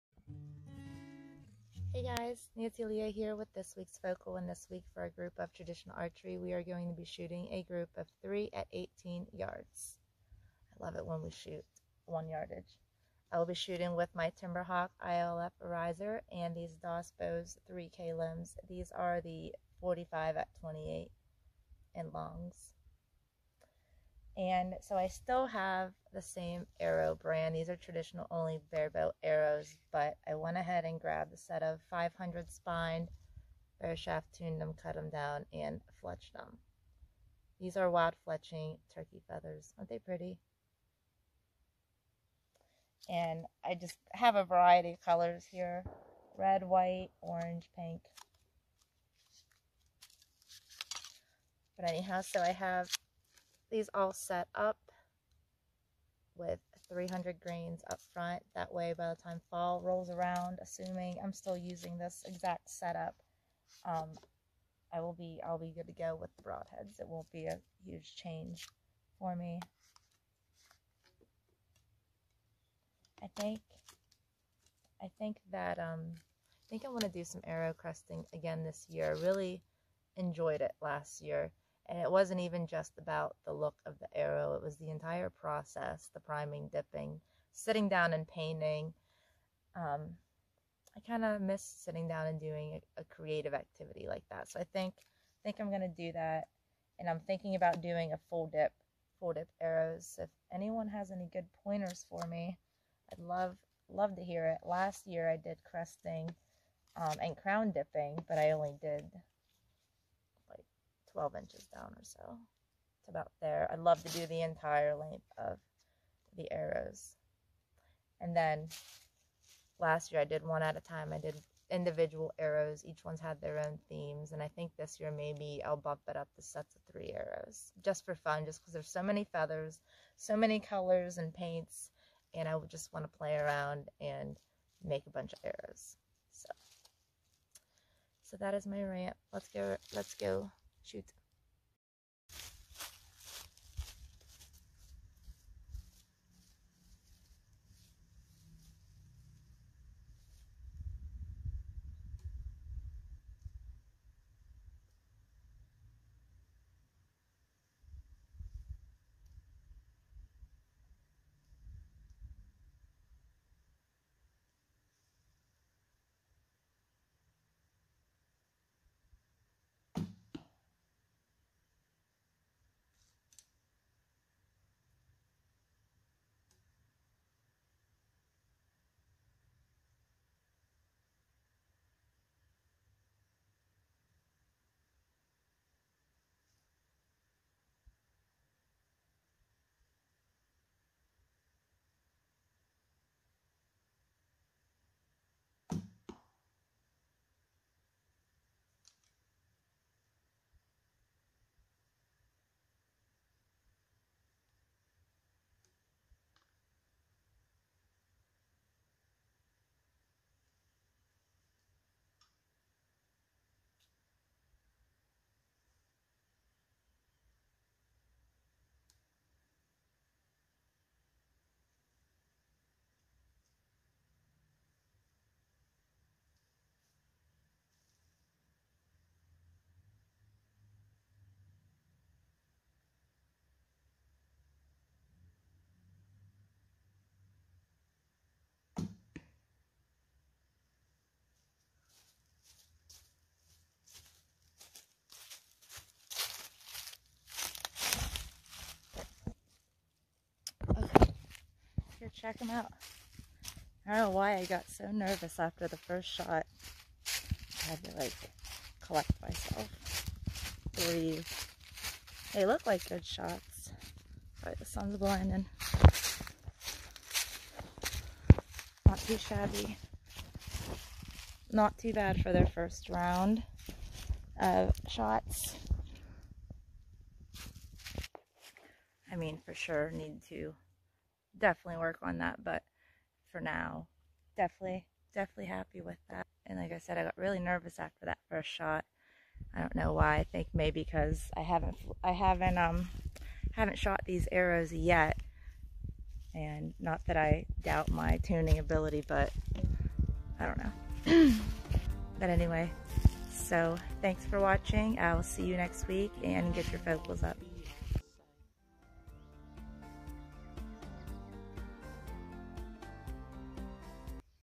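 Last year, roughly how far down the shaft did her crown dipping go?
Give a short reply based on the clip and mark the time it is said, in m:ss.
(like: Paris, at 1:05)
12 inches, at 1:51.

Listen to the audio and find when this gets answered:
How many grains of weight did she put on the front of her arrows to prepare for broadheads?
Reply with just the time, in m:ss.
0:56.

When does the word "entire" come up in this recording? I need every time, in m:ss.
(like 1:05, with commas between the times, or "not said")
1:24, 1:54.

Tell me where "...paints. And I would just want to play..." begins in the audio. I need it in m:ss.
2:11.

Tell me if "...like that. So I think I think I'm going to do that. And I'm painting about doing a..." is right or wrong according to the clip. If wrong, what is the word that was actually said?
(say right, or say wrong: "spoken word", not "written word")
wrong: "thinking", not "painting".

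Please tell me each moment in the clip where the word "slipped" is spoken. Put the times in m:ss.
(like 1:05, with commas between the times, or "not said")
not said.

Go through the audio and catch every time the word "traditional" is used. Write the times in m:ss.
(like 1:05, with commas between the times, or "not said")
0:05, 0:27.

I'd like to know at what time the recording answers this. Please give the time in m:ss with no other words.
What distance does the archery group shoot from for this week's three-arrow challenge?
0:08.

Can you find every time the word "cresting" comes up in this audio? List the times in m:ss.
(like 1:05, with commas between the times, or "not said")
1:17, 1:45.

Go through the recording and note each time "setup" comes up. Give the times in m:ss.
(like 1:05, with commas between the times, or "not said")
1:02.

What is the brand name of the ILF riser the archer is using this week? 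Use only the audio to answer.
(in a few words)
Timberhawk.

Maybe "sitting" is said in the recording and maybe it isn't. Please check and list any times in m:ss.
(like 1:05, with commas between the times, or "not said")
1:27, 1:31.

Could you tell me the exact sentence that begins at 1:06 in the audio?
It won't be a huge change for me.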